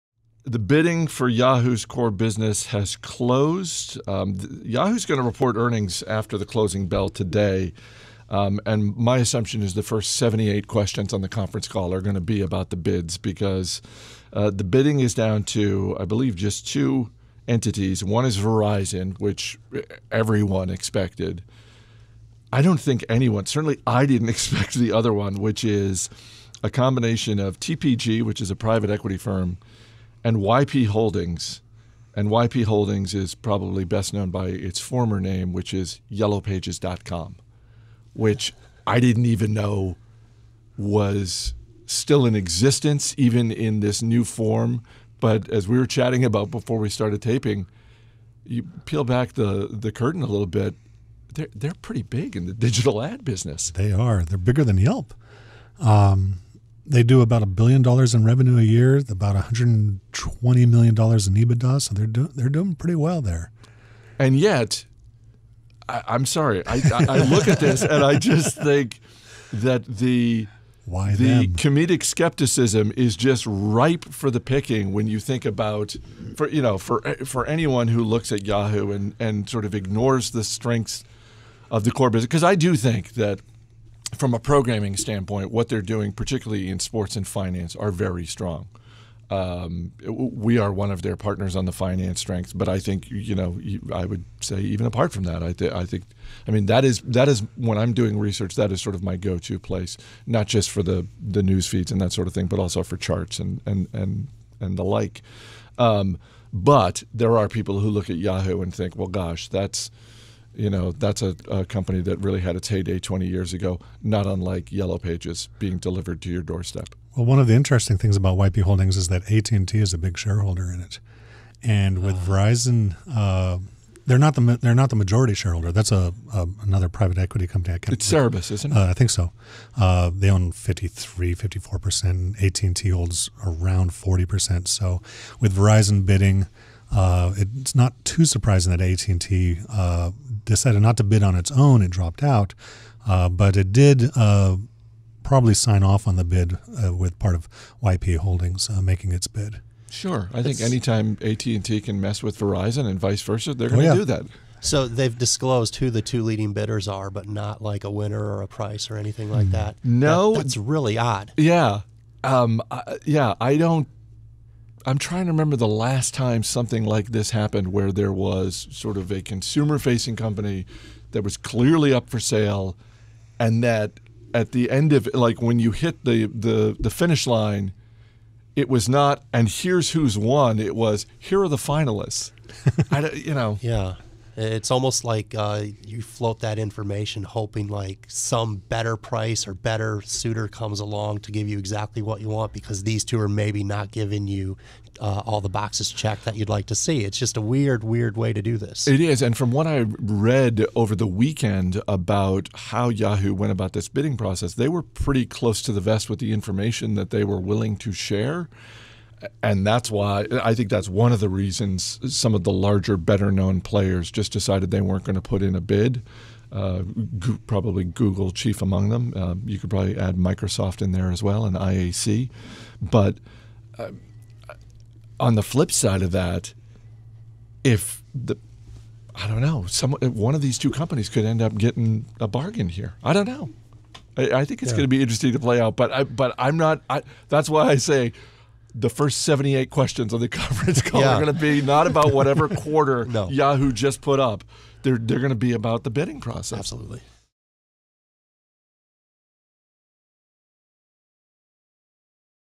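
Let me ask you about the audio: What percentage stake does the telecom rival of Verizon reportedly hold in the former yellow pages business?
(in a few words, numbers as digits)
40 percent.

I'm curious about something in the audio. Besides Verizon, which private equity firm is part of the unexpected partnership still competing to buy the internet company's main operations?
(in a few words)
TPG.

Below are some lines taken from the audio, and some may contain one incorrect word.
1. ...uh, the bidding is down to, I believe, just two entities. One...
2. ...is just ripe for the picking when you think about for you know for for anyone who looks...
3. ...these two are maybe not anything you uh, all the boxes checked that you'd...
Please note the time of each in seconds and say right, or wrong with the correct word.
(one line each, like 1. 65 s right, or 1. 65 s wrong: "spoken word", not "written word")
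1. 14 s right
2. 72 s right
3. 192 s wrong: "giving", not "anything".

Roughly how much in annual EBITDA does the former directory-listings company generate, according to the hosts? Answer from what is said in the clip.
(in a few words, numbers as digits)
$120 million.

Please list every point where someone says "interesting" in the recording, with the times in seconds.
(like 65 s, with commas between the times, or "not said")
117 s, 235 s.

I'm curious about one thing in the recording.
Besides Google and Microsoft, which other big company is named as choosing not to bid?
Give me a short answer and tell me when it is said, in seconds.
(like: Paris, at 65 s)
IAC, at 221 s.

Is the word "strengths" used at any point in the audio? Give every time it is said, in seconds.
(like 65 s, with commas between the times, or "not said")
80 s, 92 s.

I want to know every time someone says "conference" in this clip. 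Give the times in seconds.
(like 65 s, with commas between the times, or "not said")
11 s, 240 s.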